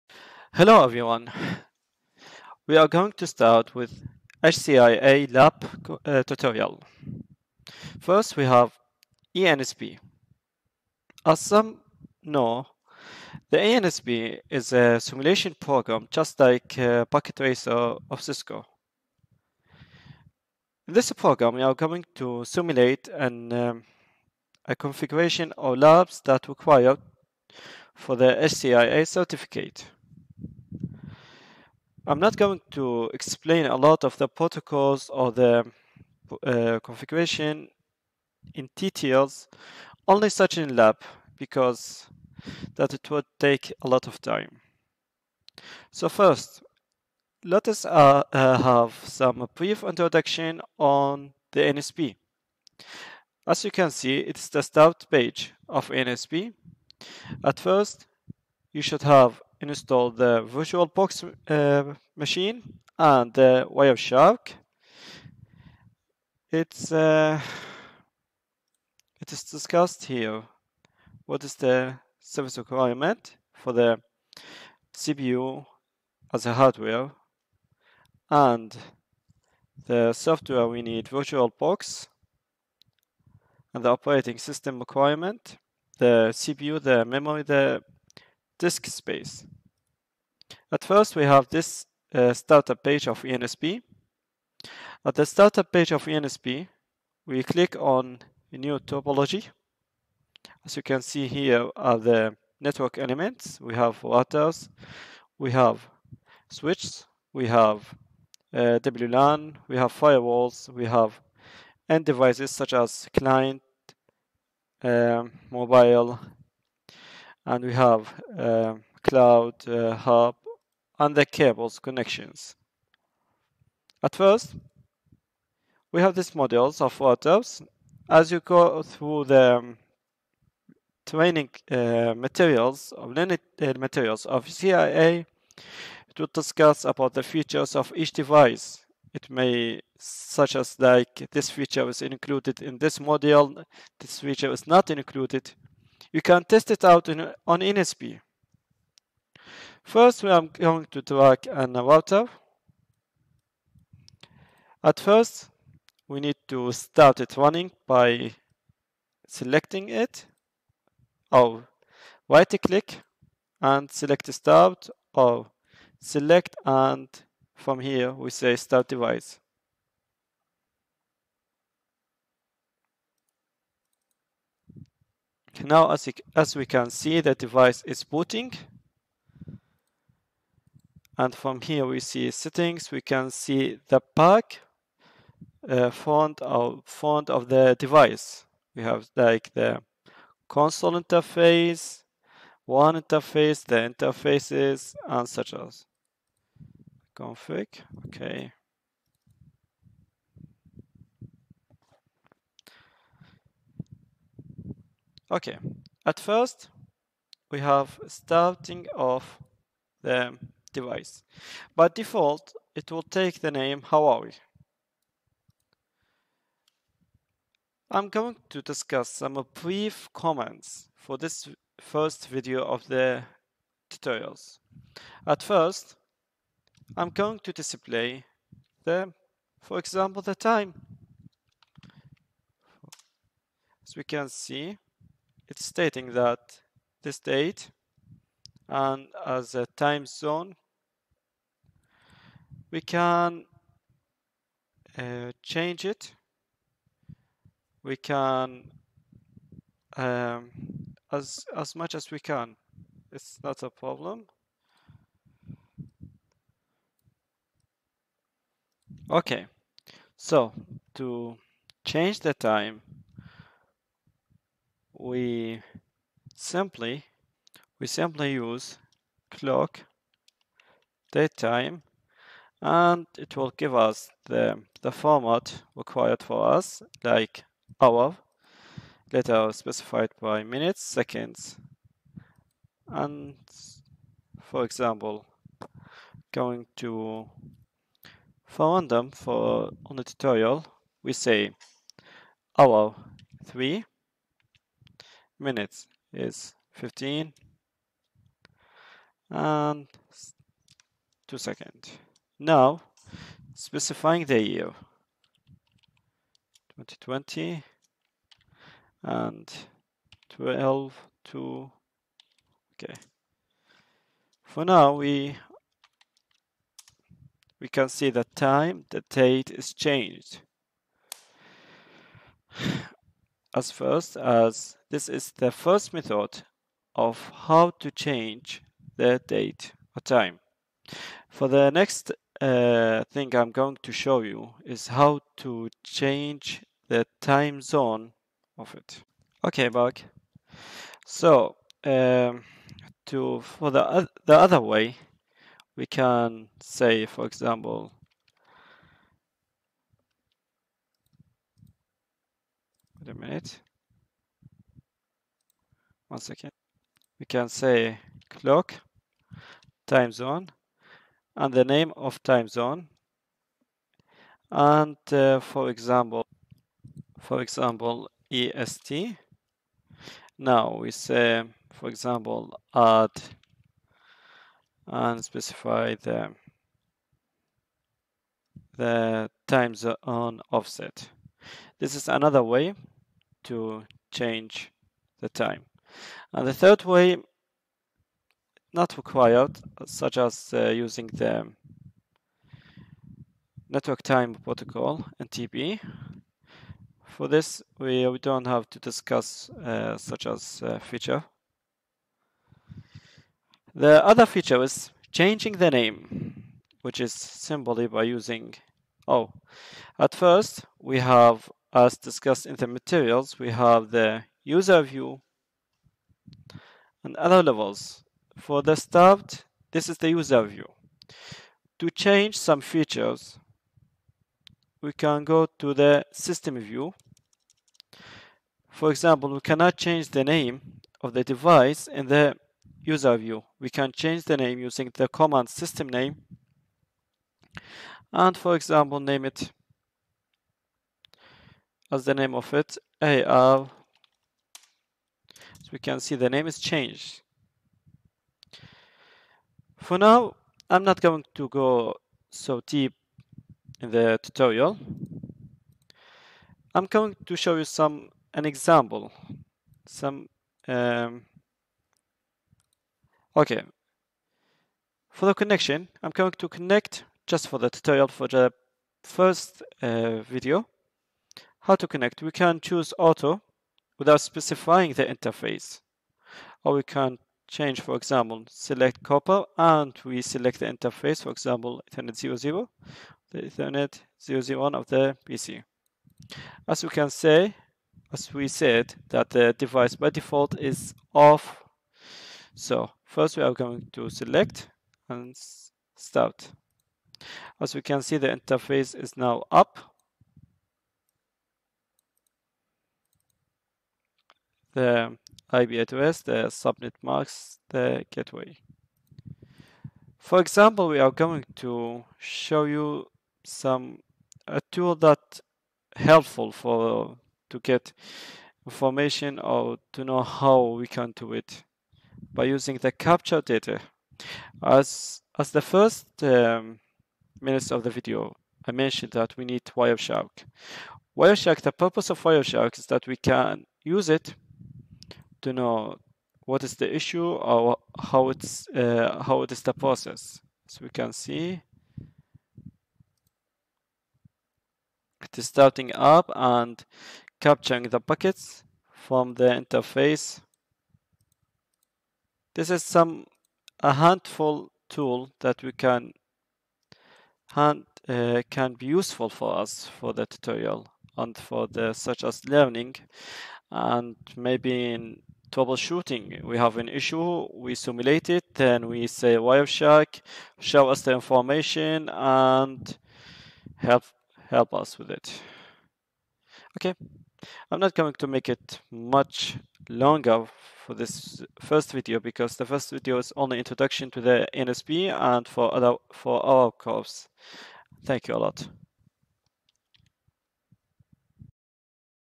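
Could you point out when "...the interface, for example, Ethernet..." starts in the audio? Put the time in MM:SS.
08:00.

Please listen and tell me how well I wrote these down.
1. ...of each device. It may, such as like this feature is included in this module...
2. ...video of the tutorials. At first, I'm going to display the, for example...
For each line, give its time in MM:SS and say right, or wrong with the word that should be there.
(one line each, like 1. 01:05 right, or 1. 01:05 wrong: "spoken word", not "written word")
1. 02:17 right
2. 03:42 right.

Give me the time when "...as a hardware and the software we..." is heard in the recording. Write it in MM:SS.
01:16.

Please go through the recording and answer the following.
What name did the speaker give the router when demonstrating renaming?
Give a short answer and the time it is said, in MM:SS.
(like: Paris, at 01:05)
AR, at 07:23.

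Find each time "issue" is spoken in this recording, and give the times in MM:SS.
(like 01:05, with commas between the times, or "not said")
08:56, 09:26.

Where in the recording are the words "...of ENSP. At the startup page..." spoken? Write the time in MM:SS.
01:33.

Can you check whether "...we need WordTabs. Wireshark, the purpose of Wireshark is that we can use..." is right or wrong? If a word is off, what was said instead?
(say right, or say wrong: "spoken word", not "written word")
wrong: "Wireshark", not "WordTabs".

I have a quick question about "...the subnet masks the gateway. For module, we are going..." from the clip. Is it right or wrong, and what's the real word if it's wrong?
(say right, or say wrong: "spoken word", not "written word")
wrong: "example", not "module".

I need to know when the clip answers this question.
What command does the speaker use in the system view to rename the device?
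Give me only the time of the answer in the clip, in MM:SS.
07:15.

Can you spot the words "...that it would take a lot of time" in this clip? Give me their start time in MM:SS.
00:42.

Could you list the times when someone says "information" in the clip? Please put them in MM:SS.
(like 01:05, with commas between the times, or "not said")
08:38, 09:31.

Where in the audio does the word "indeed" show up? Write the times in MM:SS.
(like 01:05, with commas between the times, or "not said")
not said.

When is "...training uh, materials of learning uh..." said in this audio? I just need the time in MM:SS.
02:11.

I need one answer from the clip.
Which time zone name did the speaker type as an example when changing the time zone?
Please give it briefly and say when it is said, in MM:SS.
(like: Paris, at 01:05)
EST, at 06:08.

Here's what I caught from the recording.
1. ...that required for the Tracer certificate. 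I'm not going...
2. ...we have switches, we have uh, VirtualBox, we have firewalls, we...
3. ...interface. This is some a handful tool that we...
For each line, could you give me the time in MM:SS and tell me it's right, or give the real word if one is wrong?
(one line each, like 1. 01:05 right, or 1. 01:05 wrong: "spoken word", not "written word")
1. 00:26 wrong: "HCIA", not "Tracer"
2. 01:45 wrong: "WLAN", not "VirtualBox"
3. 09:09 right.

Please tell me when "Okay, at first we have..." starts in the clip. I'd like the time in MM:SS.
03:25.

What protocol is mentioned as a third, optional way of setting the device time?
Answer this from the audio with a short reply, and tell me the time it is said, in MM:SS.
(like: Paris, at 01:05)
network time protocol, at 06:33.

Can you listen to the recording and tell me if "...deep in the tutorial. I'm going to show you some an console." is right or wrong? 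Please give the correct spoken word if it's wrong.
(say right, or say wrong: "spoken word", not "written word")
wrong: "example", not "console".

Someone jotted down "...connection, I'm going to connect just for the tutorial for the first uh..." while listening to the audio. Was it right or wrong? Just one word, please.
right.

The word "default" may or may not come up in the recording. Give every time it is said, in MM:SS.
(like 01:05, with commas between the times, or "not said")
03:31, 08:10.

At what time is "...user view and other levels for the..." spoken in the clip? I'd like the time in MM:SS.
06:54.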